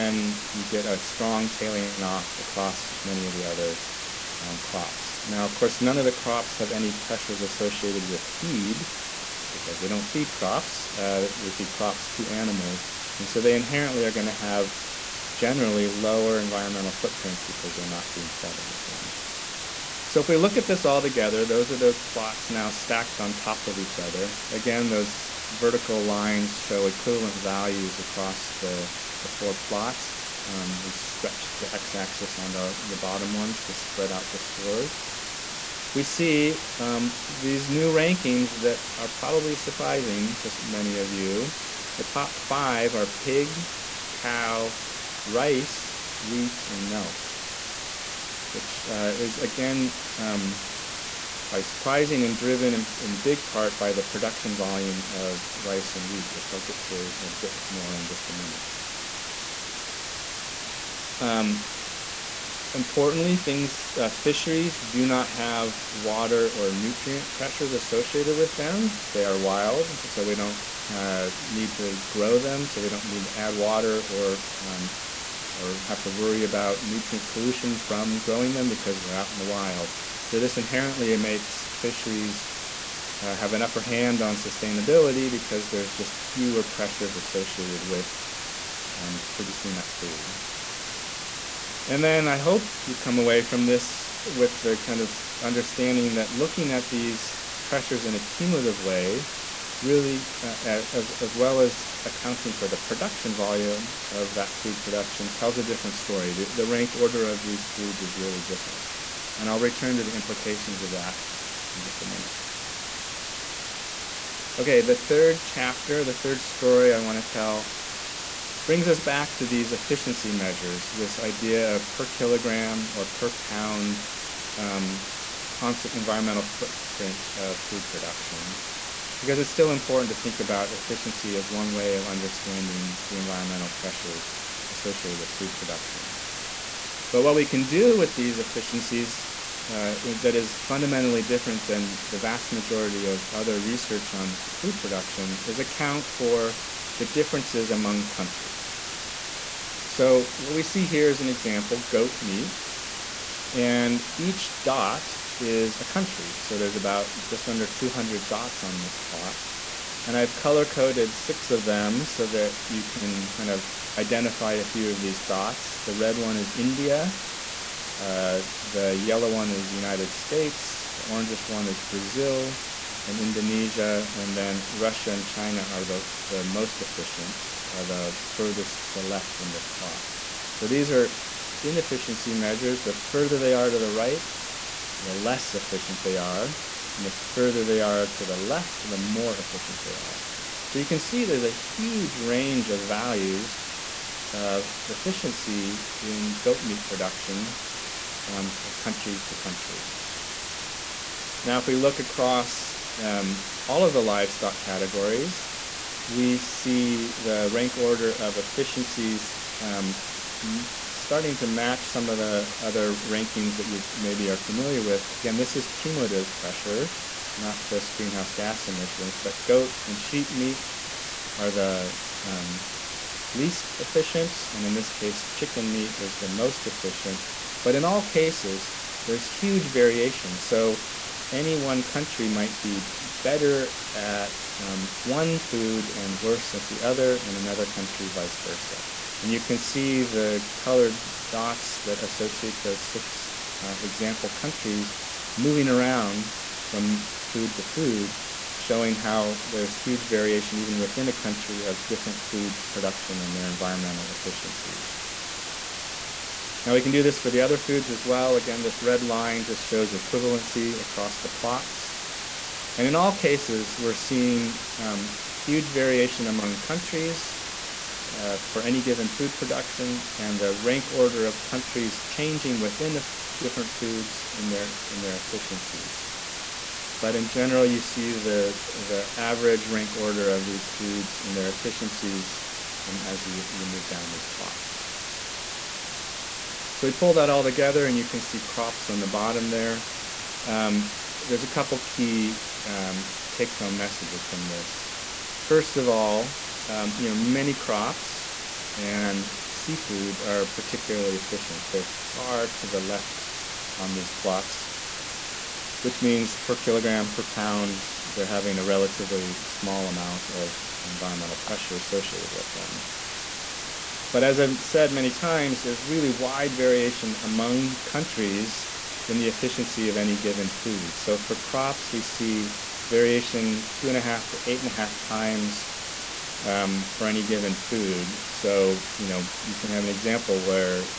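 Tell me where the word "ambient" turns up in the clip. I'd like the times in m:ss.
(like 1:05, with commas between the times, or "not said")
not said.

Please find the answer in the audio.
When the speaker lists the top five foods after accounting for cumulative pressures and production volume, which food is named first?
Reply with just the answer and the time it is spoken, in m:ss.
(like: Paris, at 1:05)
Pig, at 0:43.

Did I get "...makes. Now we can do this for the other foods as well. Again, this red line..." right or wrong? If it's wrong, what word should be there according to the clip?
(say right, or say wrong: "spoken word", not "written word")
wrong: "efficiencies", not "makes".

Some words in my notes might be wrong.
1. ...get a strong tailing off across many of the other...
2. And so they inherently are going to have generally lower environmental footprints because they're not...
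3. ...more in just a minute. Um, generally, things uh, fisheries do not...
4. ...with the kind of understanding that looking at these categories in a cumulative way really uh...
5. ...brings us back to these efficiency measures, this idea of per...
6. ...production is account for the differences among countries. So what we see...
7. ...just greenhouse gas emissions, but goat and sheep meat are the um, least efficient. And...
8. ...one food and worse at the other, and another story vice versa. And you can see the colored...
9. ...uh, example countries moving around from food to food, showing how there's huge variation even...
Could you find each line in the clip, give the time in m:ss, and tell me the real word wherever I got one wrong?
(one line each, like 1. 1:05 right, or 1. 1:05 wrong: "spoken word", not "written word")
1. 0:00 right
2. 0:13 right
3. 0:57 wrong: "importantly", not "generally"
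4. 1:34 wrong: "pressures", not "categories"
5. 1:58 right
6. 2:24 right
7. 3:37 right
8. 3:55 wrong: "country", not "story"
9. 4:03 right.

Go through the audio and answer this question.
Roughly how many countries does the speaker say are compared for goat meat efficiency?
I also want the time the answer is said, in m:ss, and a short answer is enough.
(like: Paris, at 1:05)
Just under 200, at 2:37.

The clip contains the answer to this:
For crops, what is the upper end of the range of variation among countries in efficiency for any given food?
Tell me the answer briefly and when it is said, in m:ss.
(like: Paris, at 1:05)
8.5 times, at 5:24.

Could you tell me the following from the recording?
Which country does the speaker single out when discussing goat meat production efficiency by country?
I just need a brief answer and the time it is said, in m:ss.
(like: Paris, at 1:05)
India, at 2:46.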